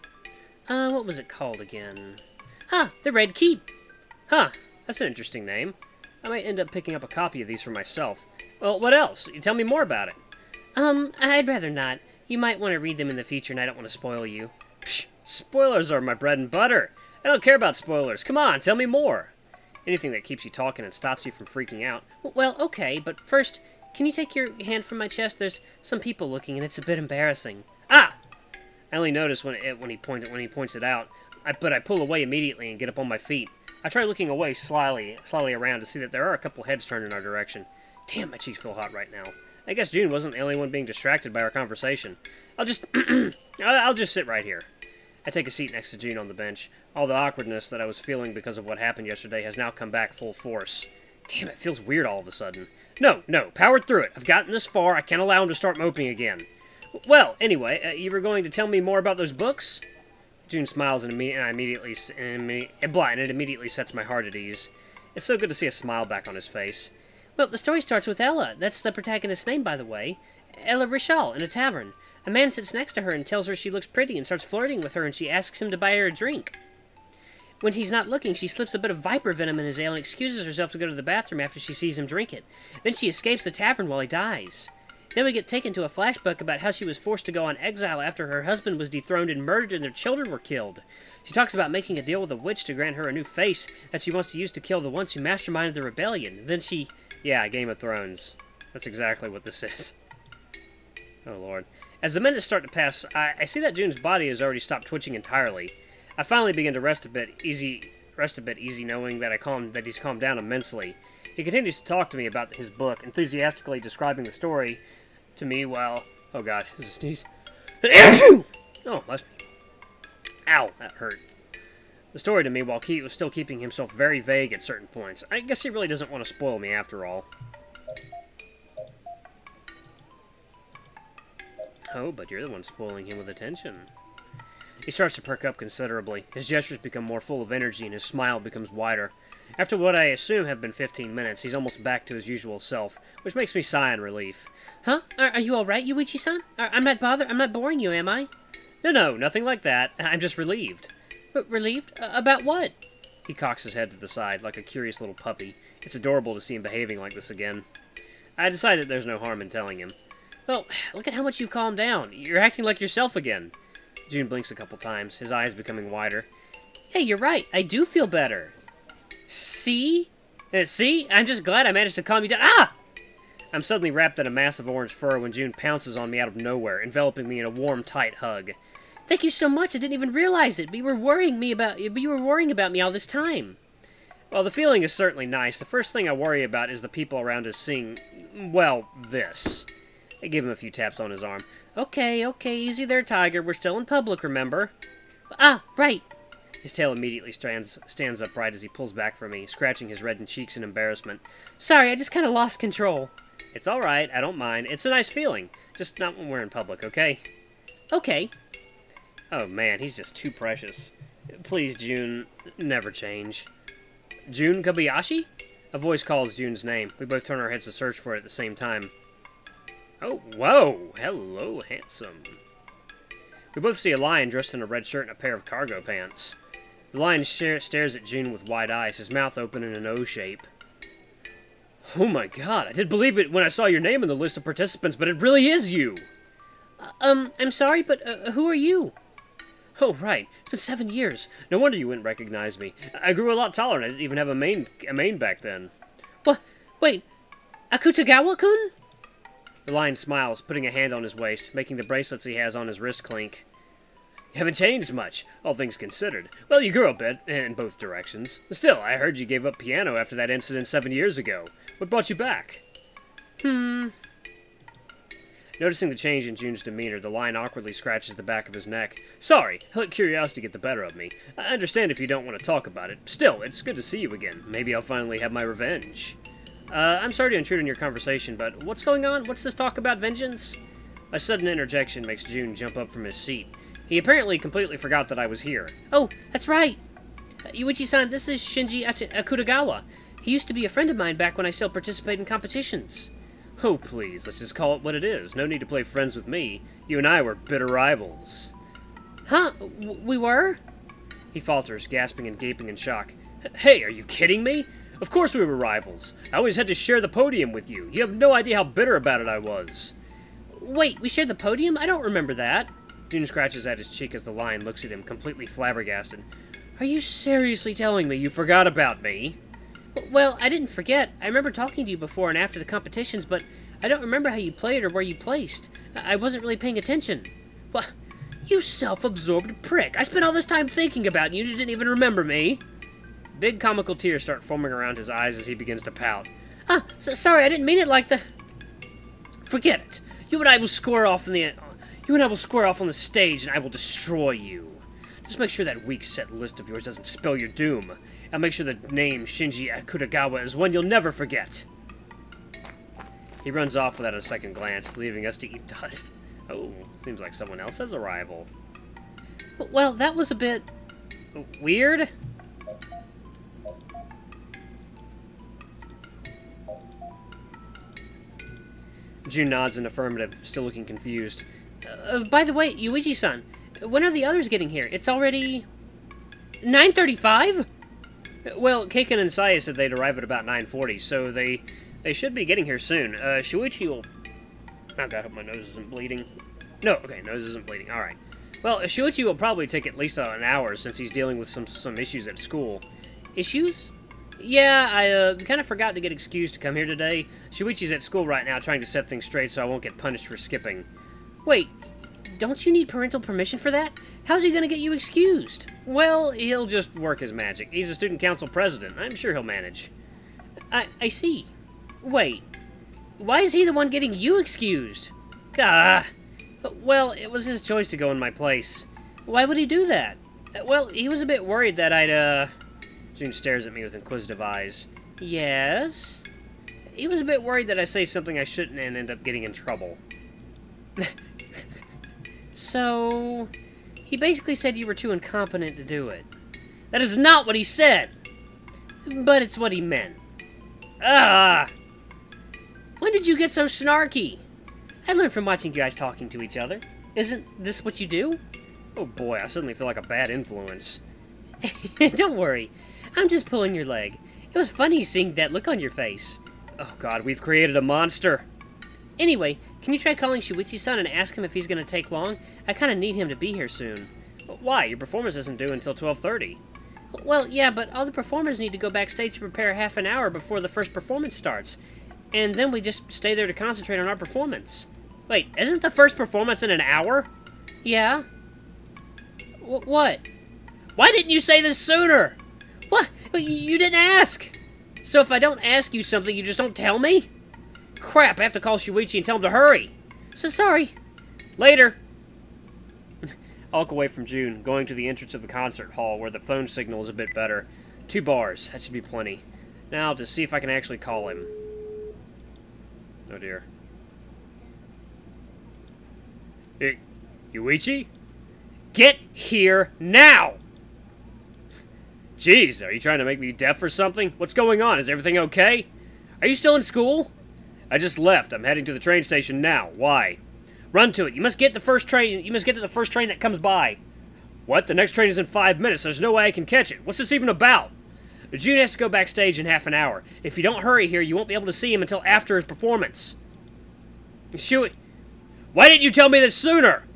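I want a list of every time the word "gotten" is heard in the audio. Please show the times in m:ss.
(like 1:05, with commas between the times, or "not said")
0:54.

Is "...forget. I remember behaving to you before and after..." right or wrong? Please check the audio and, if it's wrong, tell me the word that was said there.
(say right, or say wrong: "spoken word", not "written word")
wrong: "talking", not "behaving".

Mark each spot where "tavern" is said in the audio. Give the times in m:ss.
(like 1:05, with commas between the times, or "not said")
1:11, 1:23.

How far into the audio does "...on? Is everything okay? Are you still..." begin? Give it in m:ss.
8:34.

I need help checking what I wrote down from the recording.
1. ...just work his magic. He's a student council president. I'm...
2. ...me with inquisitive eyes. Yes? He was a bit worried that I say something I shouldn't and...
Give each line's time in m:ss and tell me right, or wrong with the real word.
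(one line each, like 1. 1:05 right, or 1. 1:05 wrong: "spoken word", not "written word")
1. 6:46 right
2. 7:03 right.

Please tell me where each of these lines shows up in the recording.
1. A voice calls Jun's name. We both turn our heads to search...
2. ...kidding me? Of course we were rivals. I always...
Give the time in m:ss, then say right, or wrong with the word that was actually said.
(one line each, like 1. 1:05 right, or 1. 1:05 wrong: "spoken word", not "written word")
1. 3:35 right
2. 5:04 right.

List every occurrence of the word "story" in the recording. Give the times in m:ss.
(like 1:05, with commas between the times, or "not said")
1:07, 1:54, 2:02.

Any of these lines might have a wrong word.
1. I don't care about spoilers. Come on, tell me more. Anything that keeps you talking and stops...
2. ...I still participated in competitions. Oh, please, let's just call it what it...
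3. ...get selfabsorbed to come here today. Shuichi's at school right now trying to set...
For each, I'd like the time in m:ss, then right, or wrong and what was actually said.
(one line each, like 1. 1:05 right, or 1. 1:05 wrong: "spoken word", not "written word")
1. 0:17 right
2. 4:51 right
3. 6:36 wrong: "excused", not "selfabsorbed".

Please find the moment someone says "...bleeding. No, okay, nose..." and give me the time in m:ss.
6:25.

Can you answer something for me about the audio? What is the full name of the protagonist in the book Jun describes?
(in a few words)
Ella Richal.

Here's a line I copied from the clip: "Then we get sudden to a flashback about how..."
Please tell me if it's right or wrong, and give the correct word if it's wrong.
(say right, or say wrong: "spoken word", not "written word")
wrong: "taken", not "sudden".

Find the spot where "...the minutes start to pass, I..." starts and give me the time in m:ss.
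1:42.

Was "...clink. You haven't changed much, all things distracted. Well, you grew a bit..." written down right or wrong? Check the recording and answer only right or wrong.
wrong.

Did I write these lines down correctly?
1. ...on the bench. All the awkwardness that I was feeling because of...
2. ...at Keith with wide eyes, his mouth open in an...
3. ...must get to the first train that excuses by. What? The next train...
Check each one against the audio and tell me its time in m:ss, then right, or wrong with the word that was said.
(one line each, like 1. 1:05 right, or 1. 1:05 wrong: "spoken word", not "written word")
1. 0:46 right
2. 3:47 wrong: "Jun", not "Keith"
3. 8:42 wrong: "comes", not "excuses".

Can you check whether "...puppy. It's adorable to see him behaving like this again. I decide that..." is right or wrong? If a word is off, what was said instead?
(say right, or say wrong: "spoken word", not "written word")
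right.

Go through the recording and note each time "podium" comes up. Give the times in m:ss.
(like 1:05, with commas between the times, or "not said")
5:07, 5:11.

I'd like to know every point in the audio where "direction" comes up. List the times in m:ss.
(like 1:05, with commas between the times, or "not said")
0:37, 4:17.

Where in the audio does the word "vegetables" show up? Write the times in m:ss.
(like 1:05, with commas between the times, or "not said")
not said.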